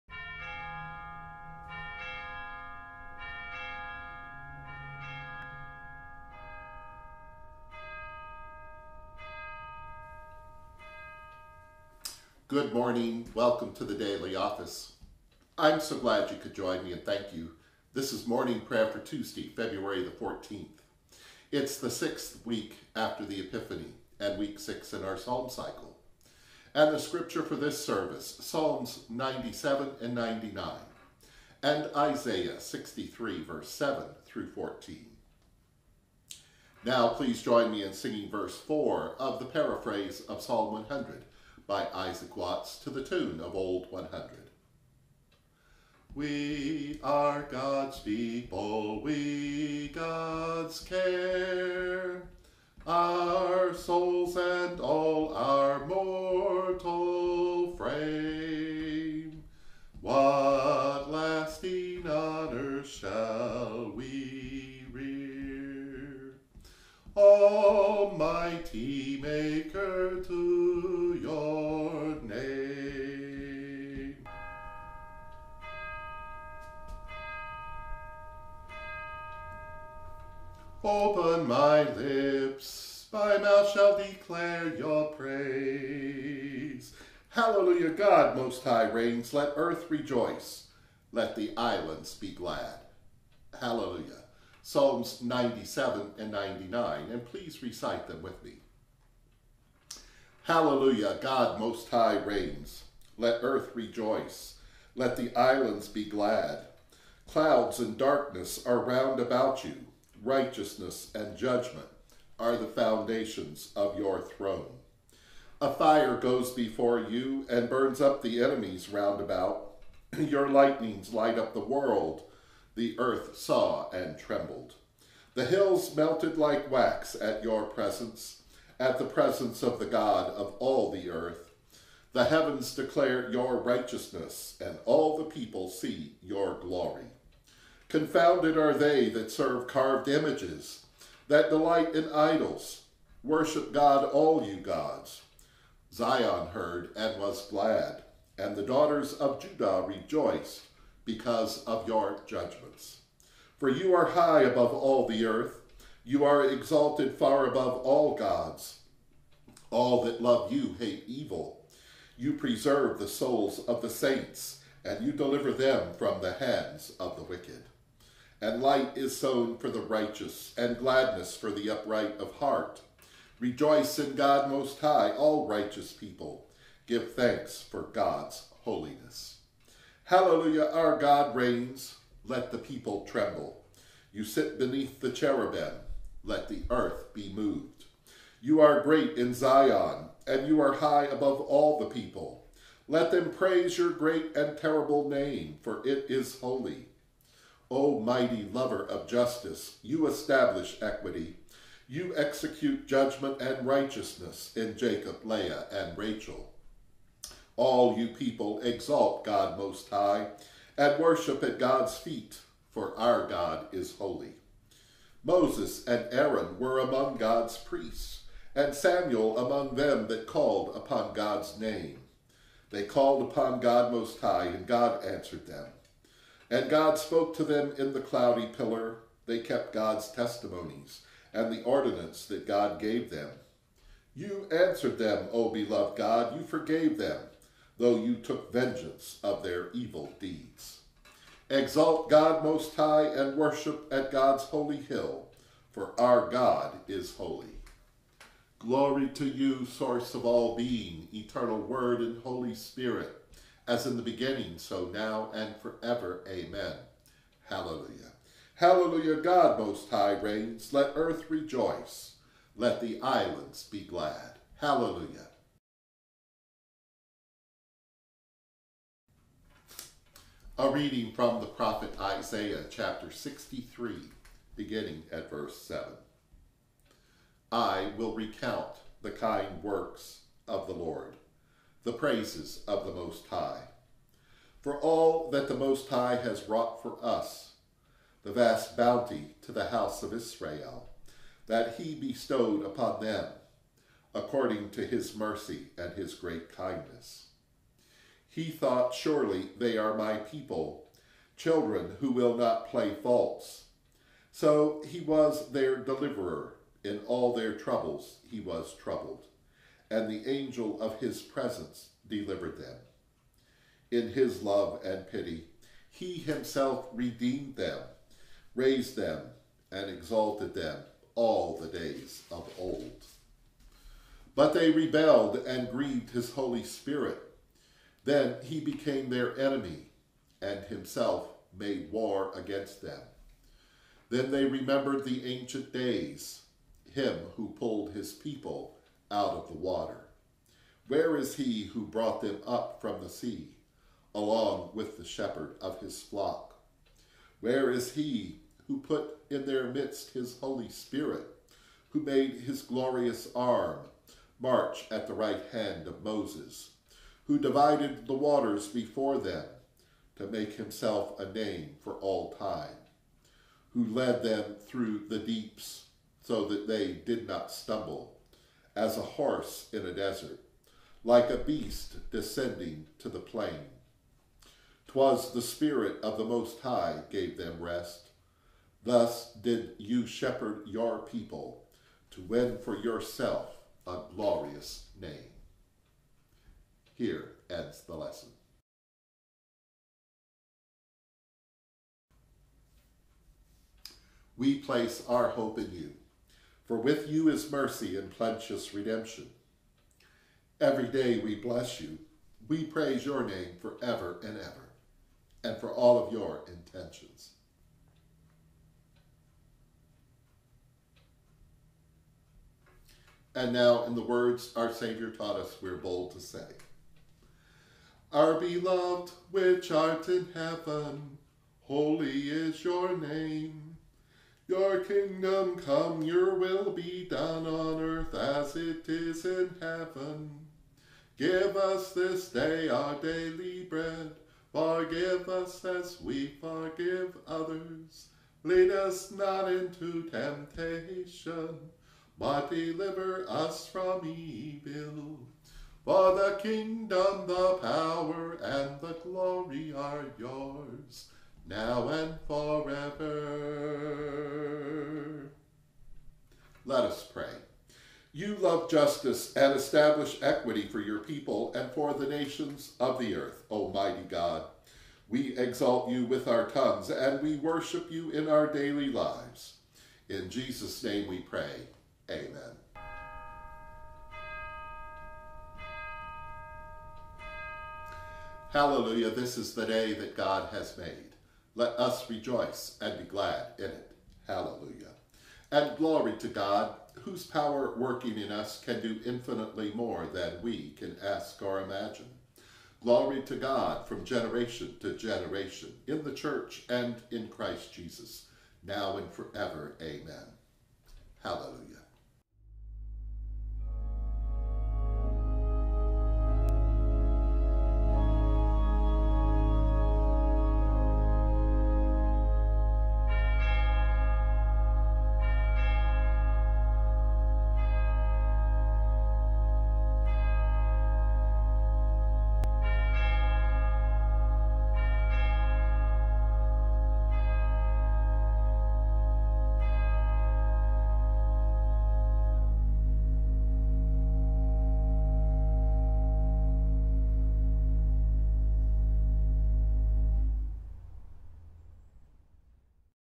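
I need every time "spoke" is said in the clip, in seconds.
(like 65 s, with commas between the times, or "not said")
226 s.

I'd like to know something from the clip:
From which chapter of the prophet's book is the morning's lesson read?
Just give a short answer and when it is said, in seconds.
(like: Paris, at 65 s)
63, at 272 s.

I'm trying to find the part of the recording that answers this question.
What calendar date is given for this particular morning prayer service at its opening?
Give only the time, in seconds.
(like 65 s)
19 s.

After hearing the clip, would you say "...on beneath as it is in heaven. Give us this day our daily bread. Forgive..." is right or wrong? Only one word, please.
wrong.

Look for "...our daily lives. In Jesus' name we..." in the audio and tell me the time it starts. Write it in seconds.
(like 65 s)
468 s.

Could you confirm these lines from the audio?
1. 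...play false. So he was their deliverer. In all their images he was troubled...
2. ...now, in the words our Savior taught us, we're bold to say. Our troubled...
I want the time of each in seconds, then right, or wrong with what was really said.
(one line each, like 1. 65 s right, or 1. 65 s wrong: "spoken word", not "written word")
1. 302 s wrong: "troubles", not "images"
2. 413 s wrong: "beloved", not "troubled".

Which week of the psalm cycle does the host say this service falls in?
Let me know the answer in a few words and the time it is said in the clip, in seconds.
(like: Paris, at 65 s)
week six, at 24 s.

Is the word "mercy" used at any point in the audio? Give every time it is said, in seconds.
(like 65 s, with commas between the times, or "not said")
295 s, 397 s.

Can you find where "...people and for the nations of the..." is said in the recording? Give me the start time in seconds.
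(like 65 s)
460 s.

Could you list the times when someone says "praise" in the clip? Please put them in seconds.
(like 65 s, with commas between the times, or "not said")
85 s, 193 s, 281 s, 402 s.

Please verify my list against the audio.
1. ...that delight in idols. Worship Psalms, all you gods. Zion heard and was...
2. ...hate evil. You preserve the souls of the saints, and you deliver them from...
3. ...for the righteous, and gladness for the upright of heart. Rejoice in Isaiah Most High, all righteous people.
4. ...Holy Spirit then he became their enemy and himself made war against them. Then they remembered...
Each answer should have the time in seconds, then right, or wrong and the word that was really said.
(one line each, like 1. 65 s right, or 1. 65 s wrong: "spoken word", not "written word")
1. 141 s wrong: "God", not "Psalms"
2. 160 s right
3. 169 s wrong: "God", not "Isaiah"
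4. 326 s right.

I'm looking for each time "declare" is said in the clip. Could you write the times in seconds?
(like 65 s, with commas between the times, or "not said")
83 s, 132 s.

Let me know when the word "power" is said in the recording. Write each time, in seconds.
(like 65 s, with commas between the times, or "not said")
447 s, 487 s.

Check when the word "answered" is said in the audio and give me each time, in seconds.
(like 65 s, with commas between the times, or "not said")
225 s, 234 s.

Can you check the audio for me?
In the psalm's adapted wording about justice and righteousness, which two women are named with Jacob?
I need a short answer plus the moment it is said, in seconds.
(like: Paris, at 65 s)
Leah and Rachel, at 205 s.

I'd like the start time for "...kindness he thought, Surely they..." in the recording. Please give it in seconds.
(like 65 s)
296 s.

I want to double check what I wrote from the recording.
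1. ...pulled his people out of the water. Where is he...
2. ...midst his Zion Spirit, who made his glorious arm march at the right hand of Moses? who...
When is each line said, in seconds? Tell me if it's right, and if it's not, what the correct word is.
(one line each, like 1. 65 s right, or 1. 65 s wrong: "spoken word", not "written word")
1. 337 s right
2. 349 s wrong: "Holy", not "Zion".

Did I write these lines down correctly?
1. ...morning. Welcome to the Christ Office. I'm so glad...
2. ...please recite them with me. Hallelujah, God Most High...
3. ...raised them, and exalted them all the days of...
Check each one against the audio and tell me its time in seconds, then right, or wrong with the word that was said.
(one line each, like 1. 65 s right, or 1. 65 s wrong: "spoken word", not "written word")
1. 12 s wrong: "Daily", not "Christ"
2. 97 s right
3. 318 s right.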